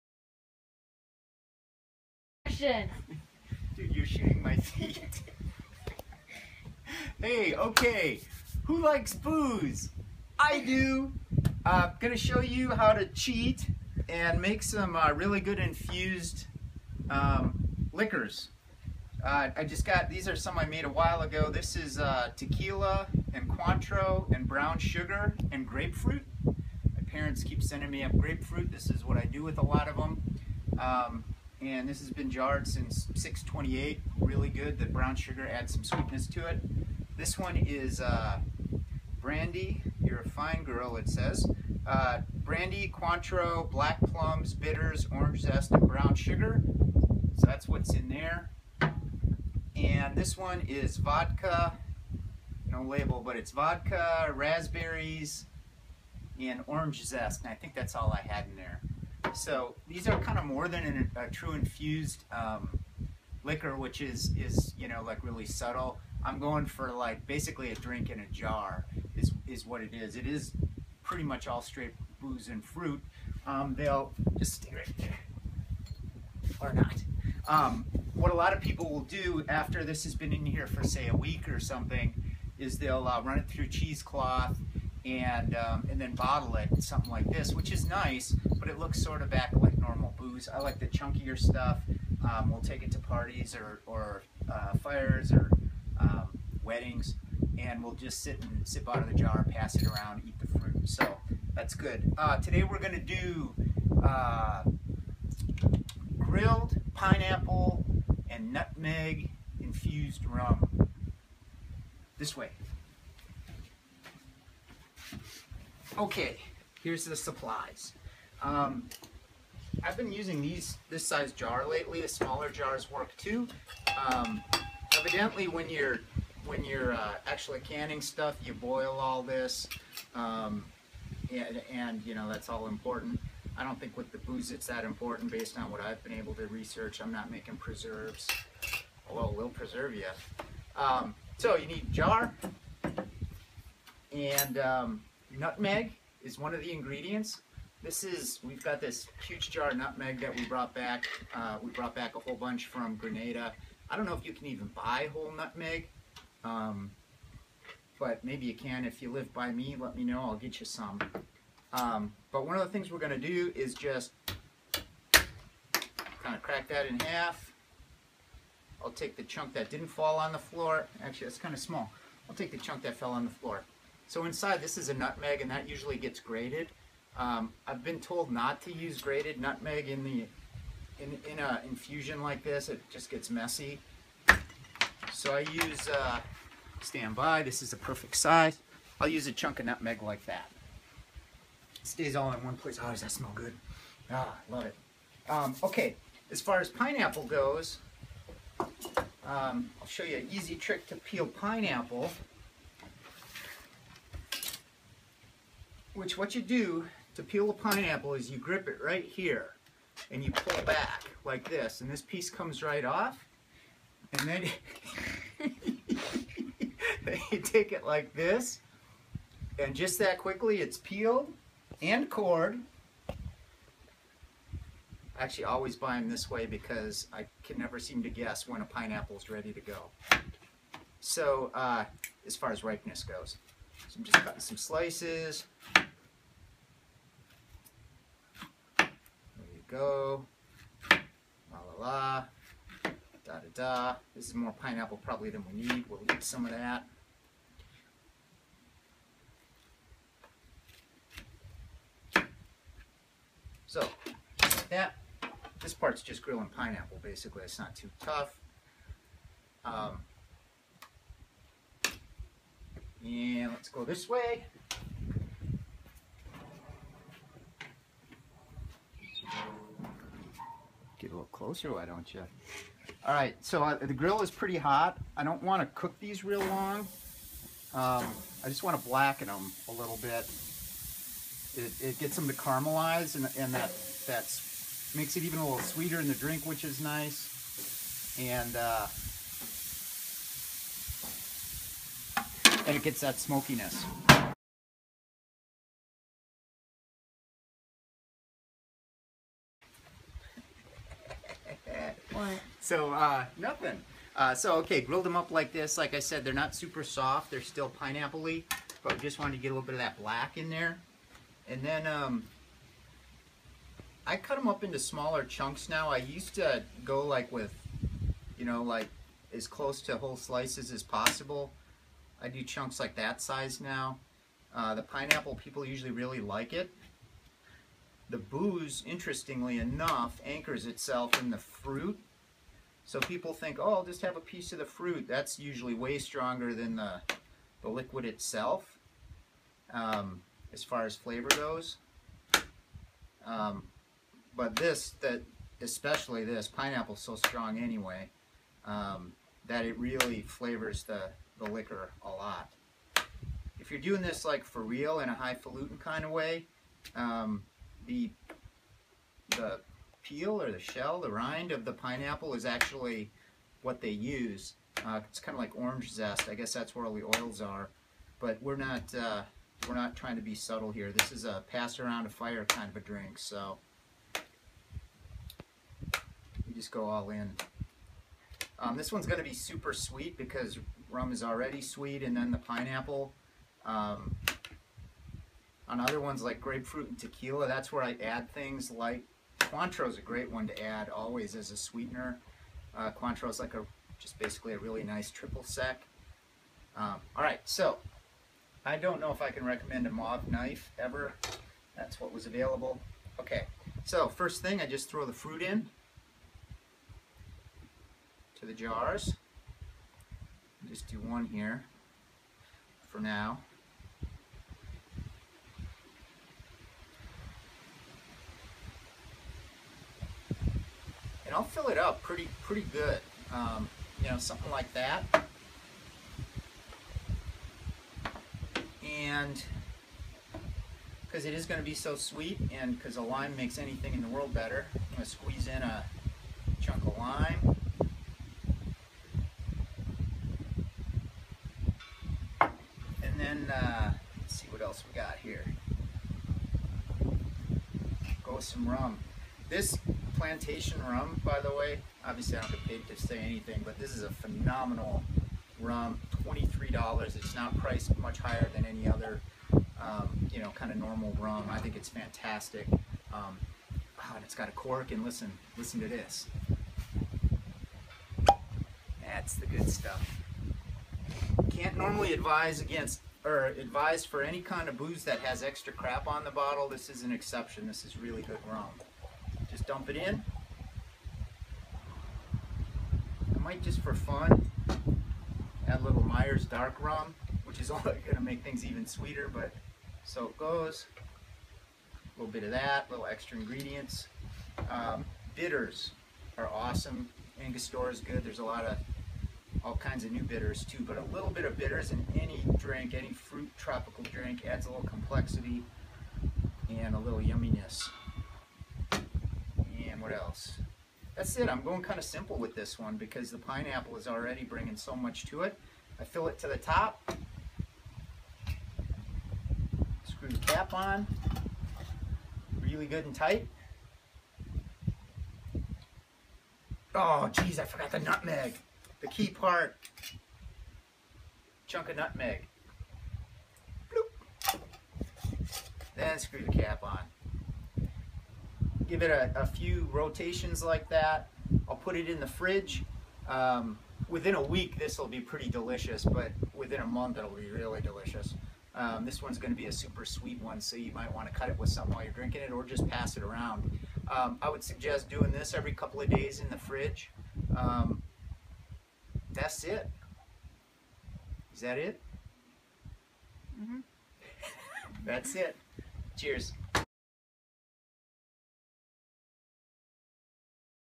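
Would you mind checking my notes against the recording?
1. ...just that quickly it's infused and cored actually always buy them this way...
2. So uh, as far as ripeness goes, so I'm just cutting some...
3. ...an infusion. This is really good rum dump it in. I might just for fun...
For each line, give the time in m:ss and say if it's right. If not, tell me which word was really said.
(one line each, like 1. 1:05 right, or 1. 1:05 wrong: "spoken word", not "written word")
1. 3:39 wrong: "peeled", not "infused"
2. 3:50 right
3. 7:57 wrong: "exception", not "infusion".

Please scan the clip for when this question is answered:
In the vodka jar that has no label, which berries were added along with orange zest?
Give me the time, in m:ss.
0:54.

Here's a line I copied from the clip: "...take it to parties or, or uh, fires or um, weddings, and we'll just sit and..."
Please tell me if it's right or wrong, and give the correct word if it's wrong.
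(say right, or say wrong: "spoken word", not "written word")
right.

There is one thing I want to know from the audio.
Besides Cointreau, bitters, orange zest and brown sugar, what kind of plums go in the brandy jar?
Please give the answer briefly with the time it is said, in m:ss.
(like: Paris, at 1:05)
black plums, at 0:43.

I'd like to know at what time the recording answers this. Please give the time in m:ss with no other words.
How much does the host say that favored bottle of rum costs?
7:36.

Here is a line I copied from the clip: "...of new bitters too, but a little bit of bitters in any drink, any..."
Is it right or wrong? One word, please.
right.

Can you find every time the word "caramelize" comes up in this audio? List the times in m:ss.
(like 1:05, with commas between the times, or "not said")
4:42.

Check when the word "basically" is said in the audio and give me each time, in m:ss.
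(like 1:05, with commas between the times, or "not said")
1:07, 4:17, 6:34.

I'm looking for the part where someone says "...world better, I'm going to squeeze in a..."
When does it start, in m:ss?
7:14.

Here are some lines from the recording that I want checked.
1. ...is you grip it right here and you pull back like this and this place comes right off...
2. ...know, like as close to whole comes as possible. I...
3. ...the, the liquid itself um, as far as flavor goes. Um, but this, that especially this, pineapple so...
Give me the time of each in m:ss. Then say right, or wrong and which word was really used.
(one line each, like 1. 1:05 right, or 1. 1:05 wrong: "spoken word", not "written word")
1. 3:28 wrong: "piece", not "place"
2. 5:18 wrong: "slices", not "comes"
3. 5:36 right.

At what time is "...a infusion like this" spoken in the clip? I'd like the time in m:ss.
3:01.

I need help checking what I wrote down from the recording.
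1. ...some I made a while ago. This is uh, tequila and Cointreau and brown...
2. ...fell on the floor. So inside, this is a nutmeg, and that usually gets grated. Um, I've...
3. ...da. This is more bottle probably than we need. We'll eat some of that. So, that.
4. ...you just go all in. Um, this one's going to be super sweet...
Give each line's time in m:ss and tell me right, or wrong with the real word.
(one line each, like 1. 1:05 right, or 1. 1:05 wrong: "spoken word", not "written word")
1. 0:20 right
2. 2:52 right
3. 4:03 wrong: "pineapple", not "bottle"
4. 6:16 right.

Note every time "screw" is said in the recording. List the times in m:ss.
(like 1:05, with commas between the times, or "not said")
8:40, 8:56.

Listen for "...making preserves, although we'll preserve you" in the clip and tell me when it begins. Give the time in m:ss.
2:17.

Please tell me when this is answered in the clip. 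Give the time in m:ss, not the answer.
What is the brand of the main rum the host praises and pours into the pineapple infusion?
7:30.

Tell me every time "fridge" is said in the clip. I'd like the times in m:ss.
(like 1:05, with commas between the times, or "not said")
9:02, 9:16.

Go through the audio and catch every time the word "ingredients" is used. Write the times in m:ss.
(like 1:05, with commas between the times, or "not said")
2:26, 8:13.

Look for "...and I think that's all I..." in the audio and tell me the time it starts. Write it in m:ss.
0:57.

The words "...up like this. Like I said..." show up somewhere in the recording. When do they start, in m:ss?
5:05.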